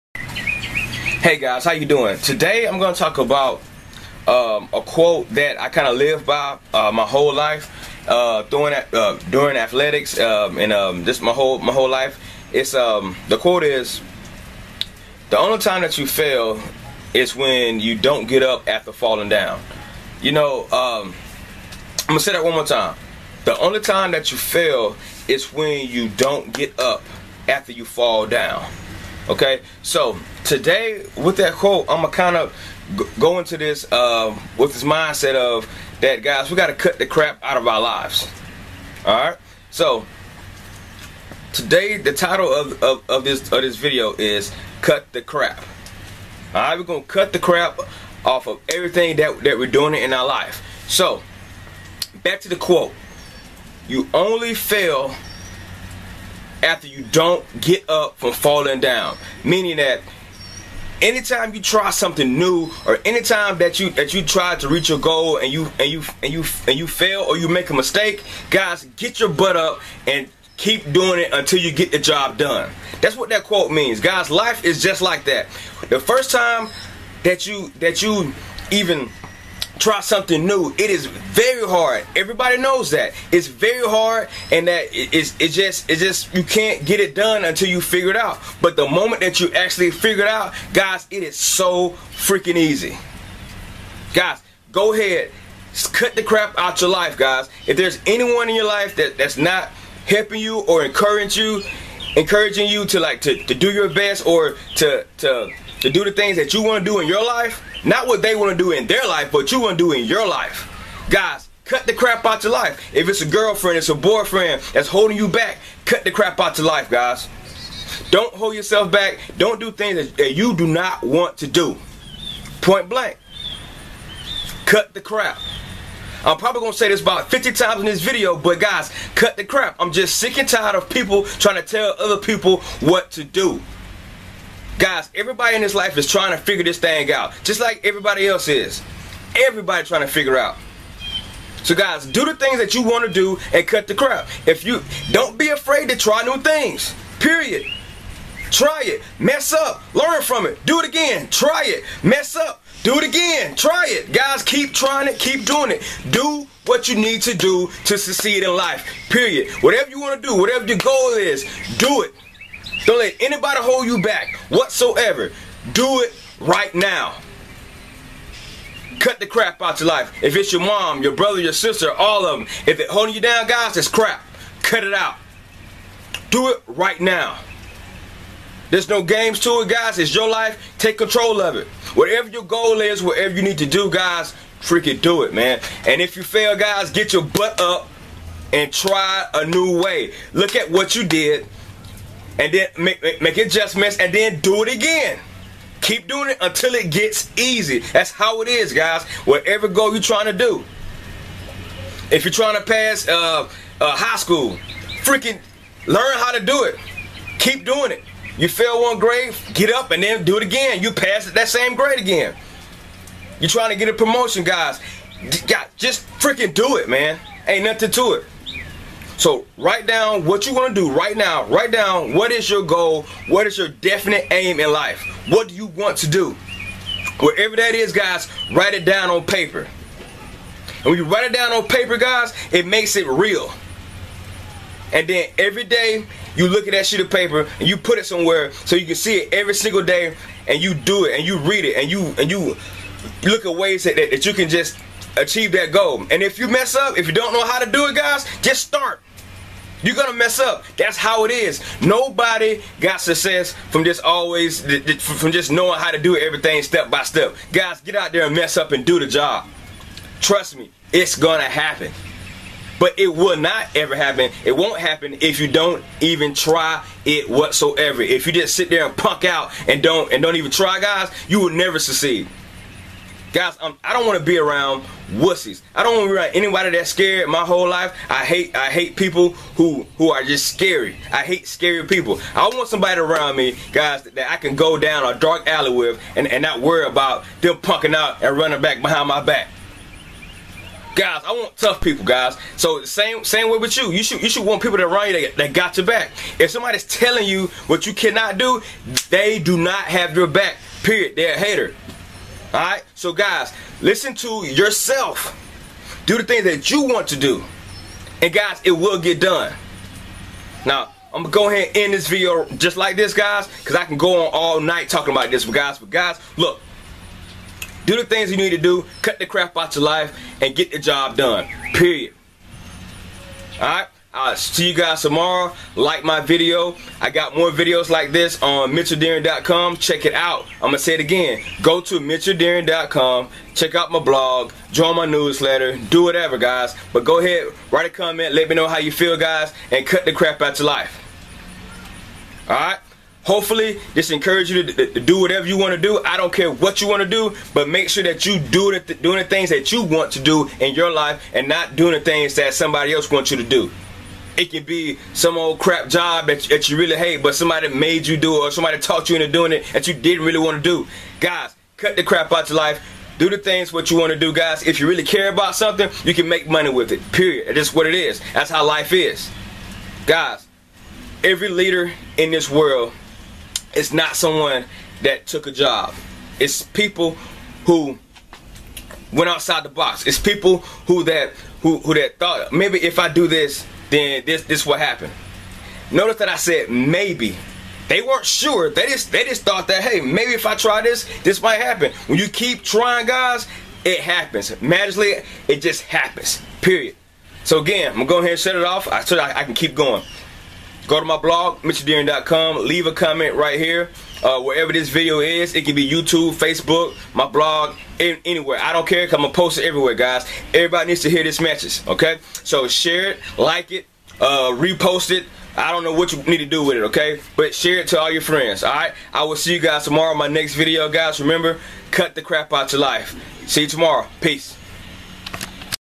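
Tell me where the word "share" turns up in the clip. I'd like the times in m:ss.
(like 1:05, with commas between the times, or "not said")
6:52, 6:57.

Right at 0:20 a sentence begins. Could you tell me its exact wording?
You know, um, I'm gonna say that one more time.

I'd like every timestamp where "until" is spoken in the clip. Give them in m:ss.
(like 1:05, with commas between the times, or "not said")
1:11, 1:27, 3:16.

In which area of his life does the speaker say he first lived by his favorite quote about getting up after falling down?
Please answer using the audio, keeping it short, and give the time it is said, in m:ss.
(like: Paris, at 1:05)
Athletics, at 0:09.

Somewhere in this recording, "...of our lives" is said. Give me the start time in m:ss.
0:37.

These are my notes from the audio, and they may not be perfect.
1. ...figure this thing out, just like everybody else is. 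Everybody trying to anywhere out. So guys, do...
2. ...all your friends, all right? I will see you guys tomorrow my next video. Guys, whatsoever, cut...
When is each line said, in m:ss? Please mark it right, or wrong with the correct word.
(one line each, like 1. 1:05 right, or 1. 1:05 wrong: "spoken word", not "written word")
1. 2:16 wrong: "figure", not "anywhere"
2. 6:57 wrong: "remember", not "whatsoever".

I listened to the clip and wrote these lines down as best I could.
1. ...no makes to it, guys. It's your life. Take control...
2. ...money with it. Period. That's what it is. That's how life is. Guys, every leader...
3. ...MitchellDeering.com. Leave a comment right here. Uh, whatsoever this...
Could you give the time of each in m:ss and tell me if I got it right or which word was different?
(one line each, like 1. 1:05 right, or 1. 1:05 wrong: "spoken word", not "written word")
1. 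2:58 wrong: "games", not "makes"
2. 6:06 right
3. 6:41 wrong: "wherever", not "whatsoever".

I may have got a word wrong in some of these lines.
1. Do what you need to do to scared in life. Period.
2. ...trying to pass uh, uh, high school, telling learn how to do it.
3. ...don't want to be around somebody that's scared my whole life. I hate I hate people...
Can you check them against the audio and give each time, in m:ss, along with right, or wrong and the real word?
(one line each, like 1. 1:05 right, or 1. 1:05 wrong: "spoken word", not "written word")
1. 2:36 wrong: "succeed", not "scared"
2. 3:22 wrong: "freaking", not "telling"
3. 4:35 wrong: "anybody", not "somebody".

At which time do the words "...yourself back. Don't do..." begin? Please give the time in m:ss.
1:58.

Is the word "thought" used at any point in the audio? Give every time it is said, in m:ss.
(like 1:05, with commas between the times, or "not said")
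6:22, 6:29.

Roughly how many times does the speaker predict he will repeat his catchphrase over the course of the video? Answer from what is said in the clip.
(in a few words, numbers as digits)
50.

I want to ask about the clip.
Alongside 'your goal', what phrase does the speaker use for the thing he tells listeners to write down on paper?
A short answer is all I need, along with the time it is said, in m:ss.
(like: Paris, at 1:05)
Definite aim, at 3:43.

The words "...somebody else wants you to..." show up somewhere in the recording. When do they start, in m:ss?
5:52.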